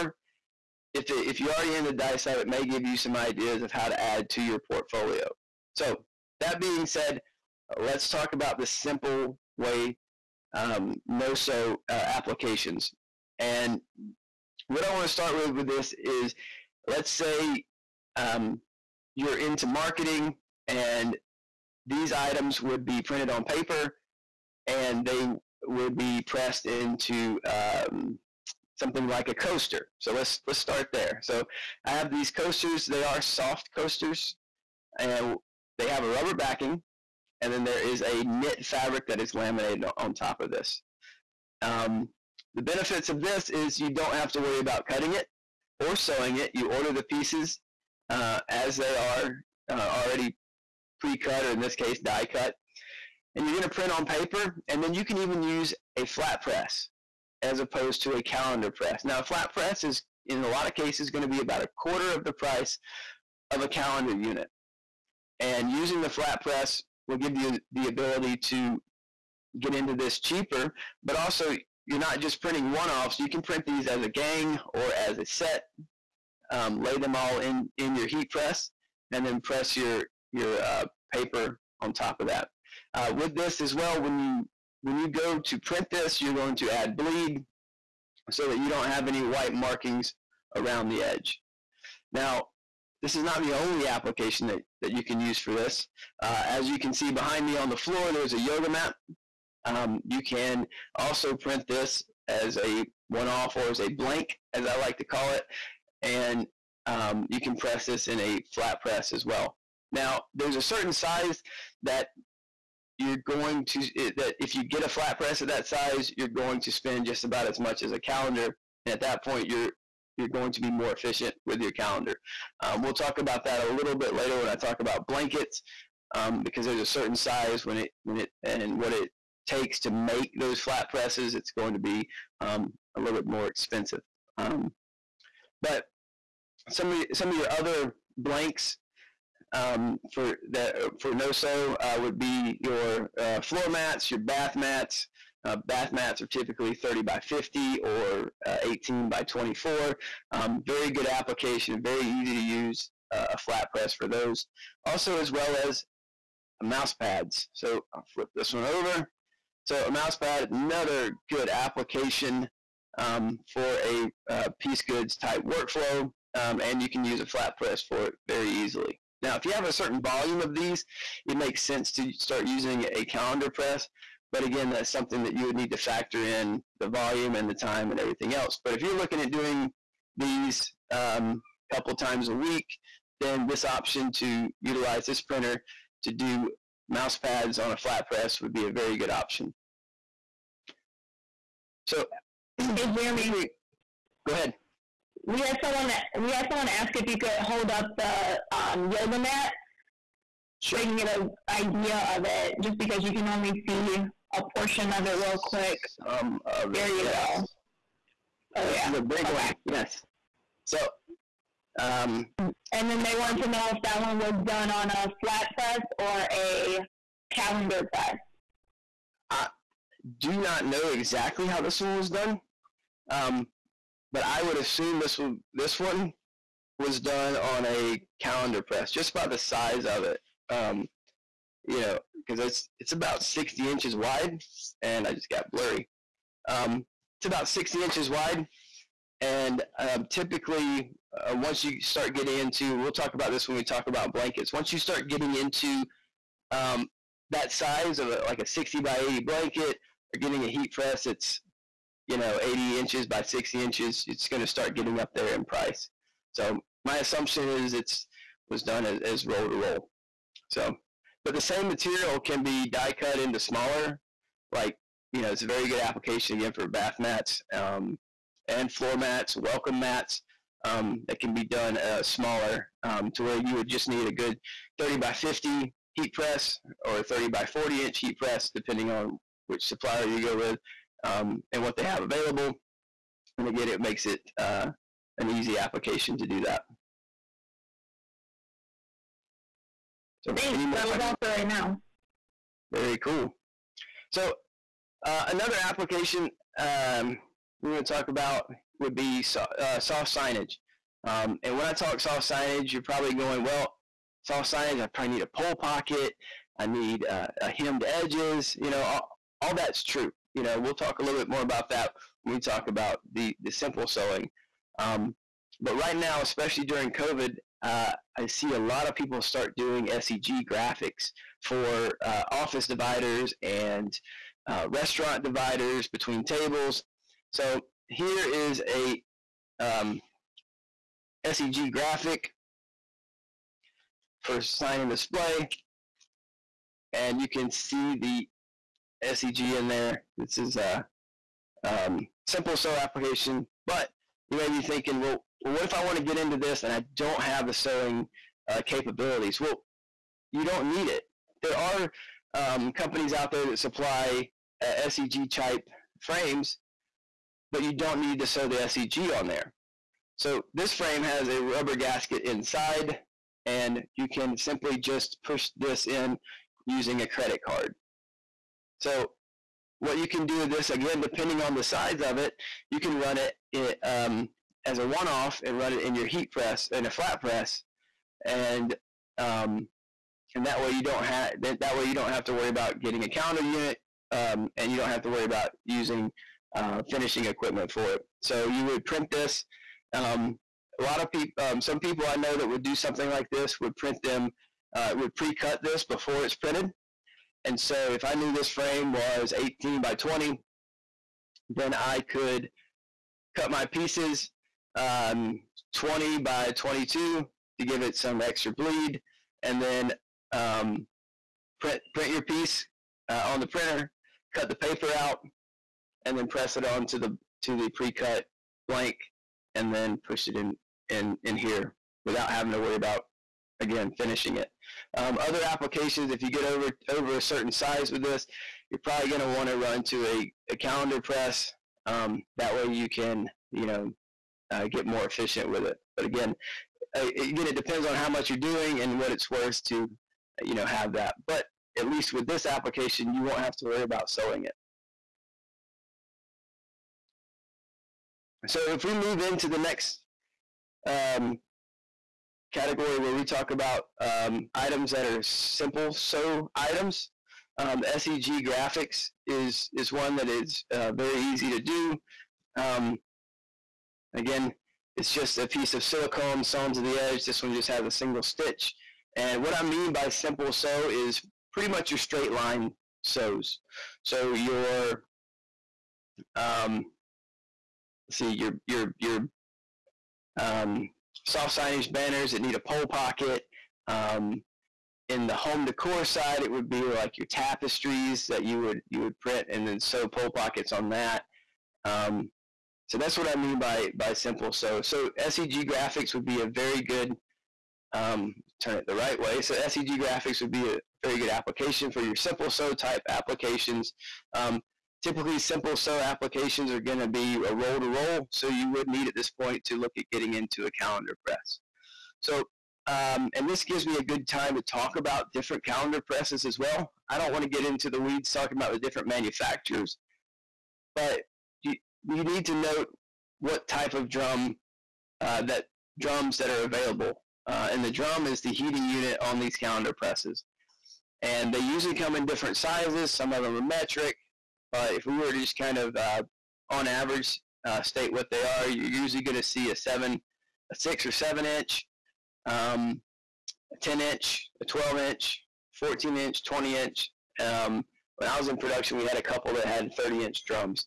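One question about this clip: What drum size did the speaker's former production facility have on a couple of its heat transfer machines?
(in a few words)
30 inch.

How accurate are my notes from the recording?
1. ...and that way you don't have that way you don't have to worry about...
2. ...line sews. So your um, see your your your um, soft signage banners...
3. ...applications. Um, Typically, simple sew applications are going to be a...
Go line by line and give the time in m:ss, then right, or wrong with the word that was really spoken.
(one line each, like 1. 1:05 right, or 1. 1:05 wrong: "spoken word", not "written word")
1. 6:20 right
2. 7:52 right
3. 8:23 right.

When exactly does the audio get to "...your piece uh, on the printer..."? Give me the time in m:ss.
6:52.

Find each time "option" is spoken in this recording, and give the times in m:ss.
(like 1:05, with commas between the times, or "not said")
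3:03, 3:09.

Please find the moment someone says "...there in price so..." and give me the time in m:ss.
4:15.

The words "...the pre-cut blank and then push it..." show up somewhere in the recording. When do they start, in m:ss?
6:57.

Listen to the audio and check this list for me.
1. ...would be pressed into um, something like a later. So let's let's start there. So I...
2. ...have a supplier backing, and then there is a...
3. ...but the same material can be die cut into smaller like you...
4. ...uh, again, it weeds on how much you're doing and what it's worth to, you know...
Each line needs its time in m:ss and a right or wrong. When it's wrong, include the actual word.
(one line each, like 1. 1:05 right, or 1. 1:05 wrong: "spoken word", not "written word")
1. 0:25 wrong: "coaster", not "later"
2. 0:35 wrong: "rubber", not "supplier"
3. 4:21 right
4. 7:16 wrong: "depends", not "weeds".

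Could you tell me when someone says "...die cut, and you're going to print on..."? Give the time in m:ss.
0:51.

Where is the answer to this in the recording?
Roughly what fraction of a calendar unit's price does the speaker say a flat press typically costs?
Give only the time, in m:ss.
1:01.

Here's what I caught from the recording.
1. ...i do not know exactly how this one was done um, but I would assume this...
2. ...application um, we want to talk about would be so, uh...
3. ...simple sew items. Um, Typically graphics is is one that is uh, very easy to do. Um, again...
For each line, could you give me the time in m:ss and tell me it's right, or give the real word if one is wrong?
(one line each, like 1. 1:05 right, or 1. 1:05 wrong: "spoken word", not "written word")
1. 3:39 right
2. 4:55 right
3. 7:35 wrong: "SEG", not "Typically".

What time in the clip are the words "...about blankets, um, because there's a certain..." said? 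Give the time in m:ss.
2:04.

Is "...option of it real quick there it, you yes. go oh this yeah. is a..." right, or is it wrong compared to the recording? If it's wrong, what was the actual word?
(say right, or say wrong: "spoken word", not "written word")
wrong: "portion", not "option".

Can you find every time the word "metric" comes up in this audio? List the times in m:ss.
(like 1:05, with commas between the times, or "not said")
8:53.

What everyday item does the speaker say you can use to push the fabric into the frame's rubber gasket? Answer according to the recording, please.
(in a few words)
a credit card.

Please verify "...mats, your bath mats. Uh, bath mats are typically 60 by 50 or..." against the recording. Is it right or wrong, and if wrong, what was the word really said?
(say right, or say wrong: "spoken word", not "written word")
wrong: "30", not "60".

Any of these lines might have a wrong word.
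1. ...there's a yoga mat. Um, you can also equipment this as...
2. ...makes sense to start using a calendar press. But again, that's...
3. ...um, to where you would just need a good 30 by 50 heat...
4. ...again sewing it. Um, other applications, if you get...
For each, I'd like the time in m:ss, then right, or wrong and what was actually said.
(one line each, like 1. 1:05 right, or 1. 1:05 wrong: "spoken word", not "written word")
1. 1:38 wrong: "print", not "equipment"
2. 2:51 right
3. 4:32 right
4. 7:03 wrong: "finishing", not "sewing".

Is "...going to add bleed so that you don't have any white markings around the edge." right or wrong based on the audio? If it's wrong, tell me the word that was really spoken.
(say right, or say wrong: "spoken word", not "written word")
right.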